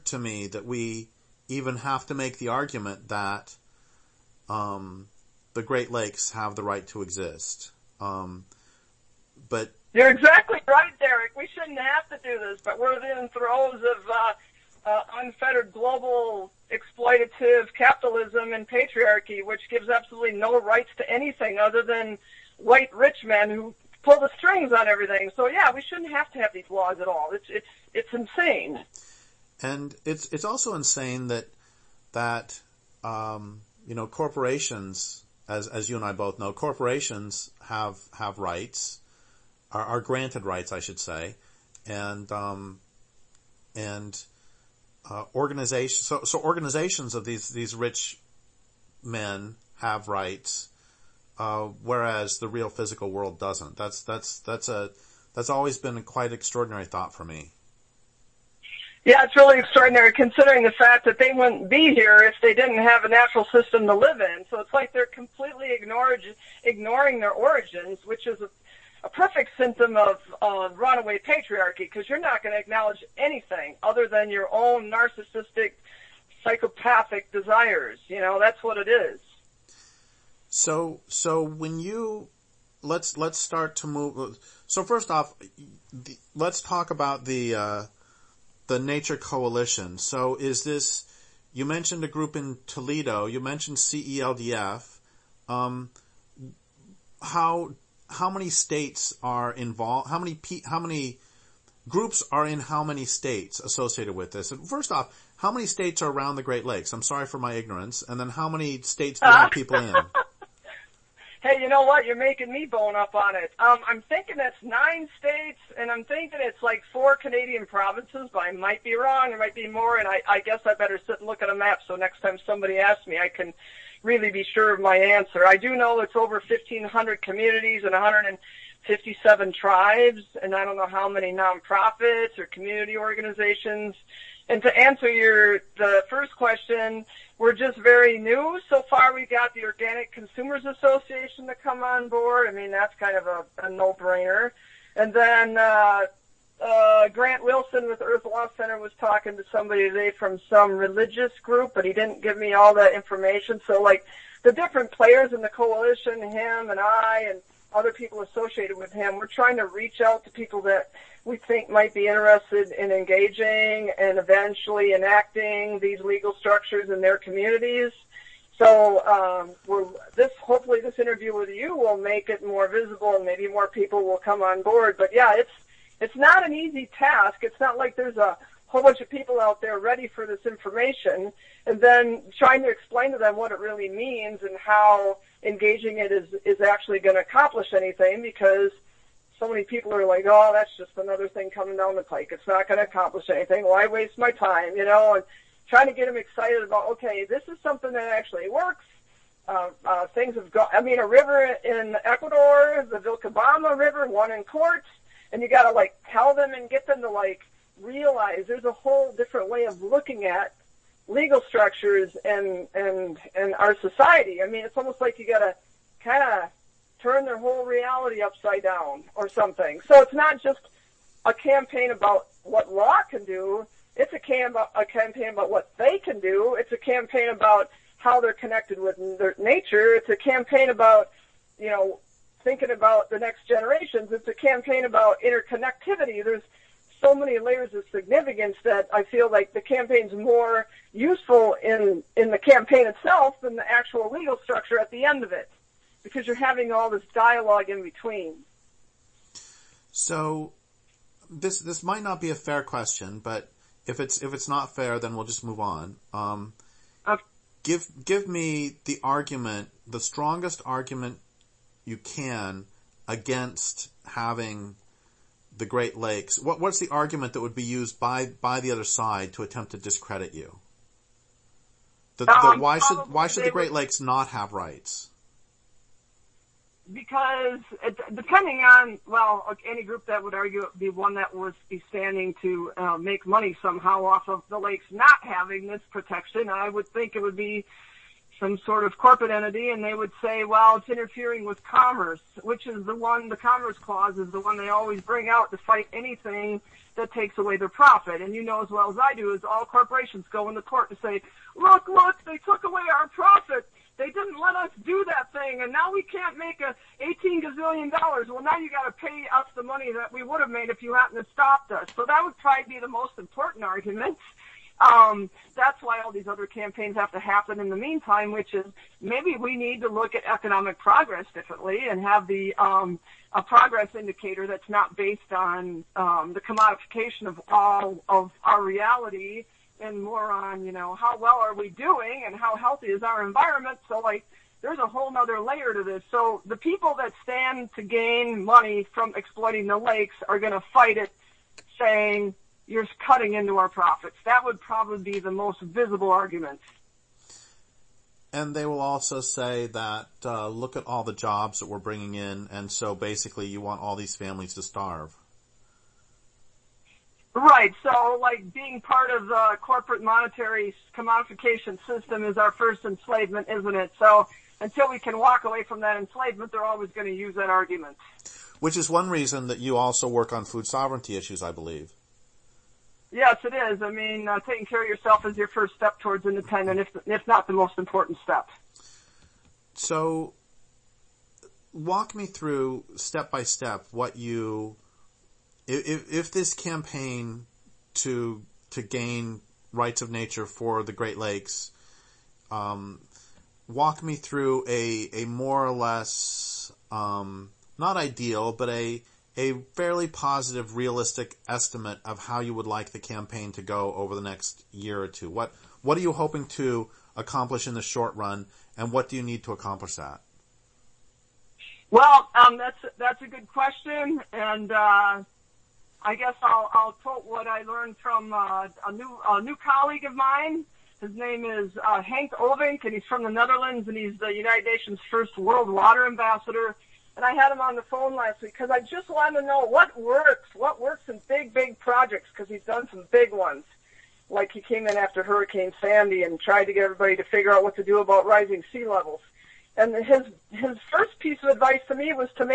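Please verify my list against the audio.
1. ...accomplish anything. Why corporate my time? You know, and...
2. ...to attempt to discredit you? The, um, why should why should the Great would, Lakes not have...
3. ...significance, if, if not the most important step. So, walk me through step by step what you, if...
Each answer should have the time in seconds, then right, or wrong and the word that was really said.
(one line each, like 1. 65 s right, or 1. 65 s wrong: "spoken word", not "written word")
1. 192 s wrong: "waste", not "corporate"
2. 269 s right
3. 376 s wrong: "independence", not "significance".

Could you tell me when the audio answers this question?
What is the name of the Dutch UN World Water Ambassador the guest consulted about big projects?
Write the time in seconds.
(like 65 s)
422 s.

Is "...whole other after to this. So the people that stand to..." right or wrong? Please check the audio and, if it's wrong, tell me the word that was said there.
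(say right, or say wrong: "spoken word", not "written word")
wrong: "layer", not "after".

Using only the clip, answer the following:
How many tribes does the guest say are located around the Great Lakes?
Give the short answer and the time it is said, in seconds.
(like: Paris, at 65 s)
157, at 127 s.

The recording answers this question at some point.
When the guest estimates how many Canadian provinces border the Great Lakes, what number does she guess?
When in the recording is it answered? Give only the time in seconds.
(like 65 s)
116 s.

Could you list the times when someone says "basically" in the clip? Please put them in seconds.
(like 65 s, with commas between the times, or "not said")
352 s.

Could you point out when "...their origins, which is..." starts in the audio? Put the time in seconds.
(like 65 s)
67 s.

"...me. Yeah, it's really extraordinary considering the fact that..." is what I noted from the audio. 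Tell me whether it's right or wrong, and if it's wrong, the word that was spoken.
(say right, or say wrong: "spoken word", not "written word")
right.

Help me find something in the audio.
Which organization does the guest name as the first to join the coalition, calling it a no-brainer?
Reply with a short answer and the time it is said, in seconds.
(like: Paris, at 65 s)
Organic Consumers Association, at 139 s.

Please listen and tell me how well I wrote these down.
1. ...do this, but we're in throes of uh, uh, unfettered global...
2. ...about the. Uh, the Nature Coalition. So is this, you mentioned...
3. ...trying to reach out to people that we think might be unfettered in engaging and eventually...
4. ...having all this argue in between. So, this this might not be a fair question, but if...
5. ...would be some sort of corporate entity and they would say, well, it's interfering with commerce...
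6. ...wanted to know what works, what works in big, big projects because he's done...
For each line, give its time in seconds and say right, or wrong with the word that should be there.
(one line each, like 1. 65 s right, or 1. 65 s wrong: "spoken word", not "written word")
1. 12 s right
2. 86 s right
3. 159 s wrong: "interested", not "unfettered"
4. 246 s wrong: "dialogue", not "argue"
5. 287 s right
6. 429 s right.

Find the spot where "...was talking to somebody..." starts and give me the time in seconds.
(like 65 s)
148 s.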